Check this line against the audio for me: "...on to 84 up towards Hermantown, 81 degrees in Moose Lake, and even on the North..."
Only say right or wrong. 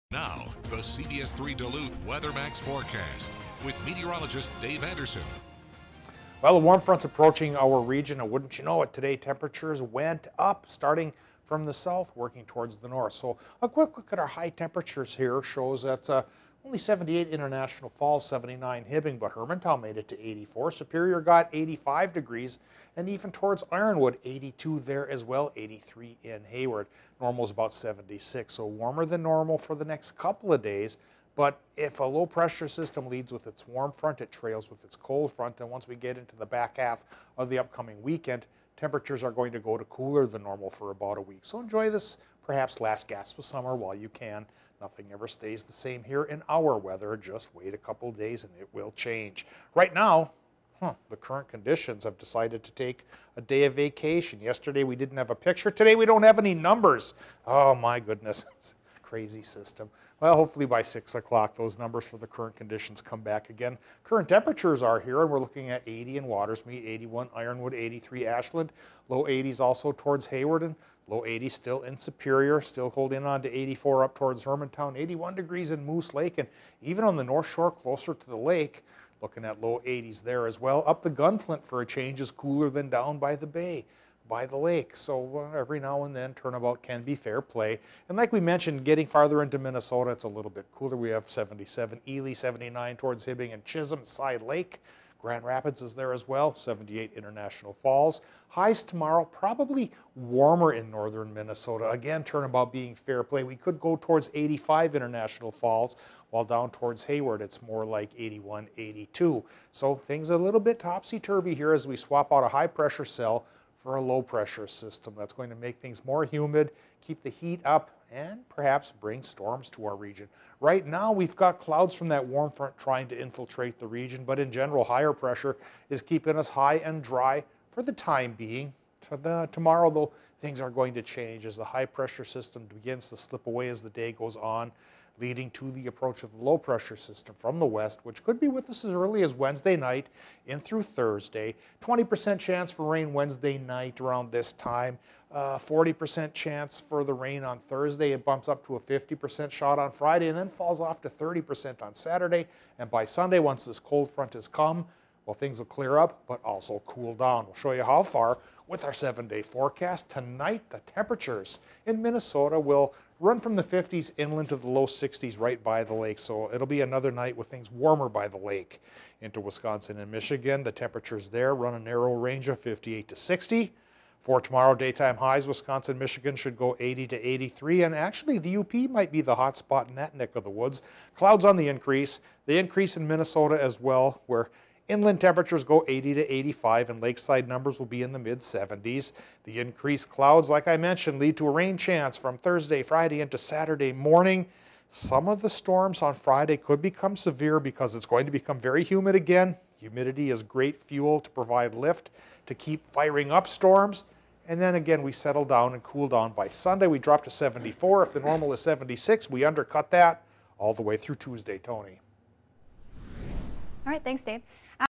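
right.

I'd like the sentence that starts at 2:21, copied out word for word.
20% chance for rain Wednesday night around this time.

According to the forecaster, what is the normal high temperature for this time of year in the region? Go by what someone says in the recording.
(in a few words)
76.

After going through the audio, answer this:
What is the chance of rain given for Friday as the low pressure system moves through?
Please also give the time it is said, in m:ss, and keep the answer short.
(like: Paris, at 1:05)
50%, at 2:28.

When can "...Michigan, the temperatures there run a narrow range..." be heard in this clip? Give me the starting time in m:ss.
2:50.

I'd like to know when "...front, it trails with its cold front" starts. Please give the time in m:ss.
0:33.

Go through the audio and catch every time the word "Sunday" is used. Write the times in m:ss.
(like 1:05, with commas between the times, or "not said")
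2:33, 3:26.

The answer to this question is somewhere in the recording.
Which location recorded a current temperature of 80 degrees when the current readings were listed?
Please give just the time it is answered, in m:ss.
1:05.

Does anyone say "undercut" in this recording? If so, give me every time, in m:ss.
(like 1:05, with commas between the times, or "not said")
3:29.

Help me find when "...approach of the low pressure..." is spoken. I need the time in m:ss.
2:15.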